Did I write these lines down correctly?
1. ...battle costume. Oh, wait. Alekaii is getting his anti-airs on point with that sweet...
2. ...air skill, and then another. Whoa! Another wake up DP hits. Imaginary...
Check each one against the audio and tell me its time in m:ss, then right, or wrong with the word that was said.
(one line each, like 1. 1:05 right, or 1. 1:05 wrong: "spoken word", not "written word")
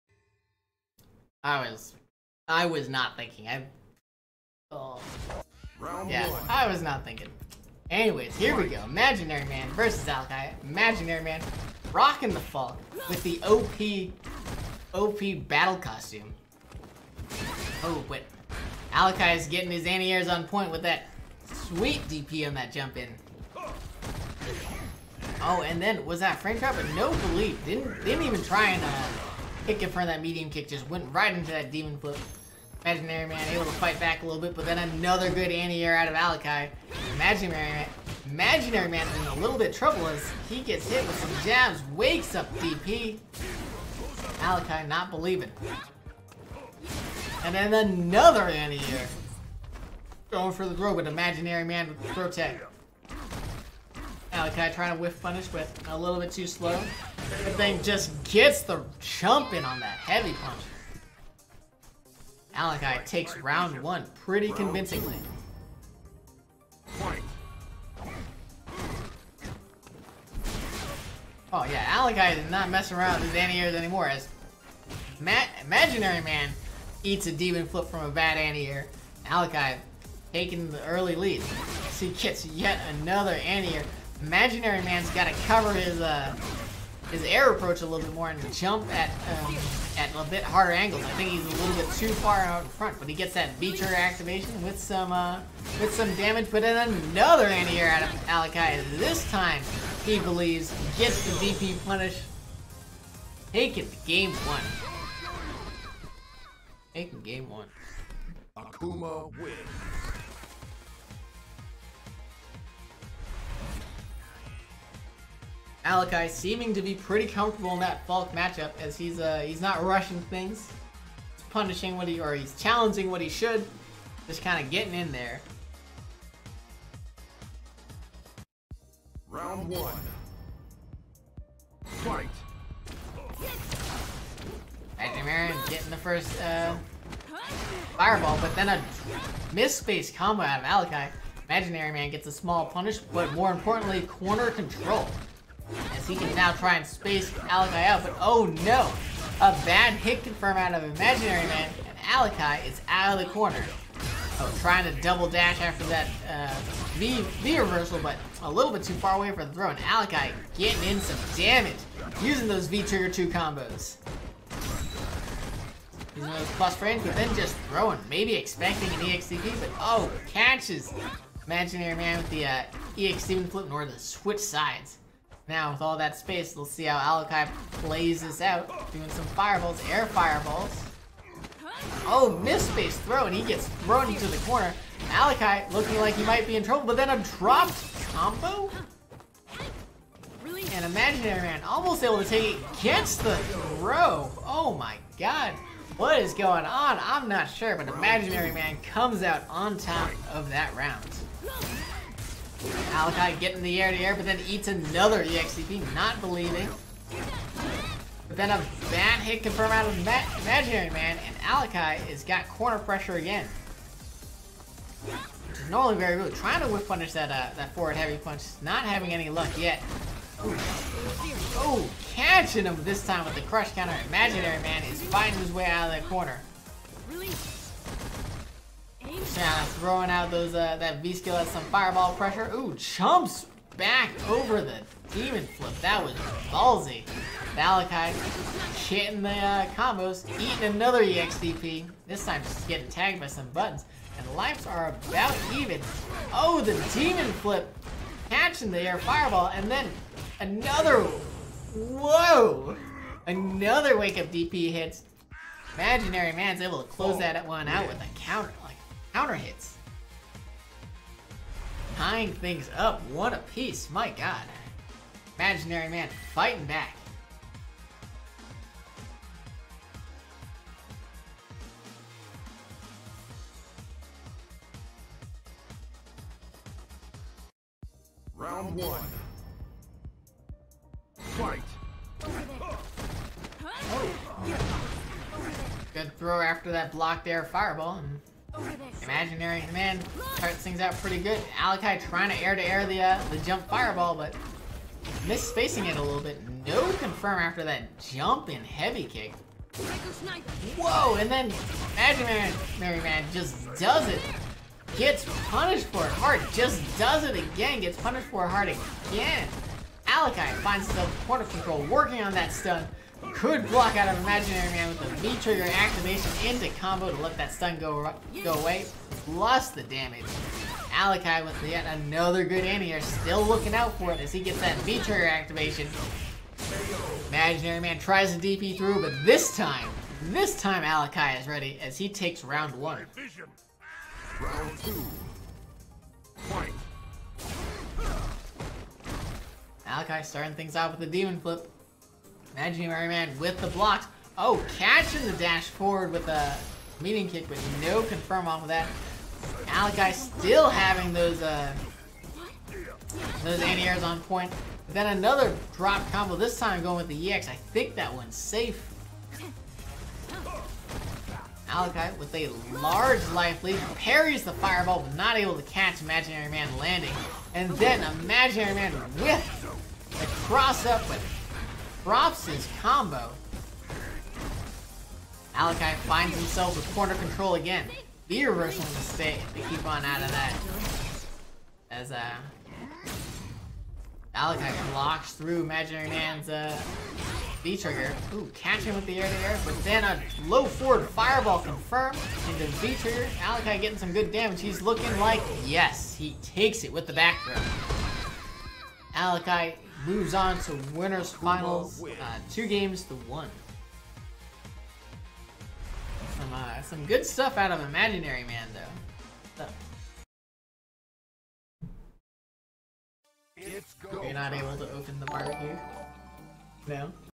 1. 0:15 right
2. 4:08 wrong: "fireball", not "skill".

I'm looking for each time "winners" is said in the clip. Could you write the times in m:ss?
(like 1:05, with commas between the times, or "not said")
6:40.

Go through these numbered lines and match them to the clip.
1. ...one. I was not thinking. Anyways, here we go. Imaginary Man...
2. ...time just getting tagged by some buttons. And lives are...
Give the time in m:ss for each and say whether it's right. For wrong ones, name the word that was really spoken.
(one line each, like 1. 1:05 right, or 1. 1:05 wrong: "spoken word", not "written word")
1. 0:06 right
2. 4:02 right.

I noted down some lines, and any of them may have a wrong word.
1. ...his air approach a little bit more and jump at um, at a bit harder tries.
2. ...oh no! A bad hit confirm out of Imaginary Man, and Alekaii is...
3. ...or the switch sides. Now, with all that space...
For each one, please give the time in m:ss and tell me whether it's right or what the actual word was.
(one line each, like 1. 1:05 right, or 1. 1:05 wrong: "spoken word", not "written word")
1. 1:27 wrong: "angles", not "tries"
2. 2:28 right
3. 2:53 right.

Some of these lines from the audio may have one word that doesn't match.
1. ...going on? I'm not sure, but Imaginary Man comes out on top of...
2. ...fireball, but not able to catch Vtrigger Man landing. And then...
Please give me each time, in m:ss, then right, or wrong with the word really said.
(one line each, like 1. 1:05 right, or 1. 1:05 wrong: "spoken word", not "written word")
1. 3:16 right
2. 6:04 wrong: "Imaginary", not "Vtrigger".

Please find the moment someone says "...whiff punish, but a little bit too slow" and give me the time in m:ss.
0:55.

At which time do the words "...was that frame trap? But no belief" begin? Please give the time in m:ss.
0:26.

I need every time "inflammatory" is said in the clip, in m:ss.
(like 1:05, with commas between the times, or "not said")
not said.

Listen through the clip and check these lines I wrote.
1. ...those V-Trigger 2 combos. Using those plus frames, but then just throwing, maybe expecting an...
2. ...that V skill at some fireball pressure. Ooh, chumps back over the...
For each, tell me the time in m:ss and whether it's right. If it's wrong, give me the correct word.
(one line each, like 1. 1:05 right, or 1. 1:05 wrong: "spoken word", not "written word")
1. 2:42 right
2. 3:50 right.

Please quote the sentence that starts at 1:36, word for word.
But in another anti-air out of Alekaii.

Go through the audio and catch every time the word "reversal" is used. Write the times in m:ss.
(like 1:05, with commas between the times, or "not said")
2:37, 6:18.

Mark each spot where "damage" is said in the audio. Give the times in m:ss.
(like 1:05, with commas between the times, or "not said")
1:36, 2:41, 5:19, 6:34.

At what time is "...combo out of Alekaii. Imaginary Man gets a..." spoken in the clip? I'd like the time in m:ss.
2:20.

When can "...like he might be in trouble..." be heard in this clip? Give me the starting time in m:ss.
3:05.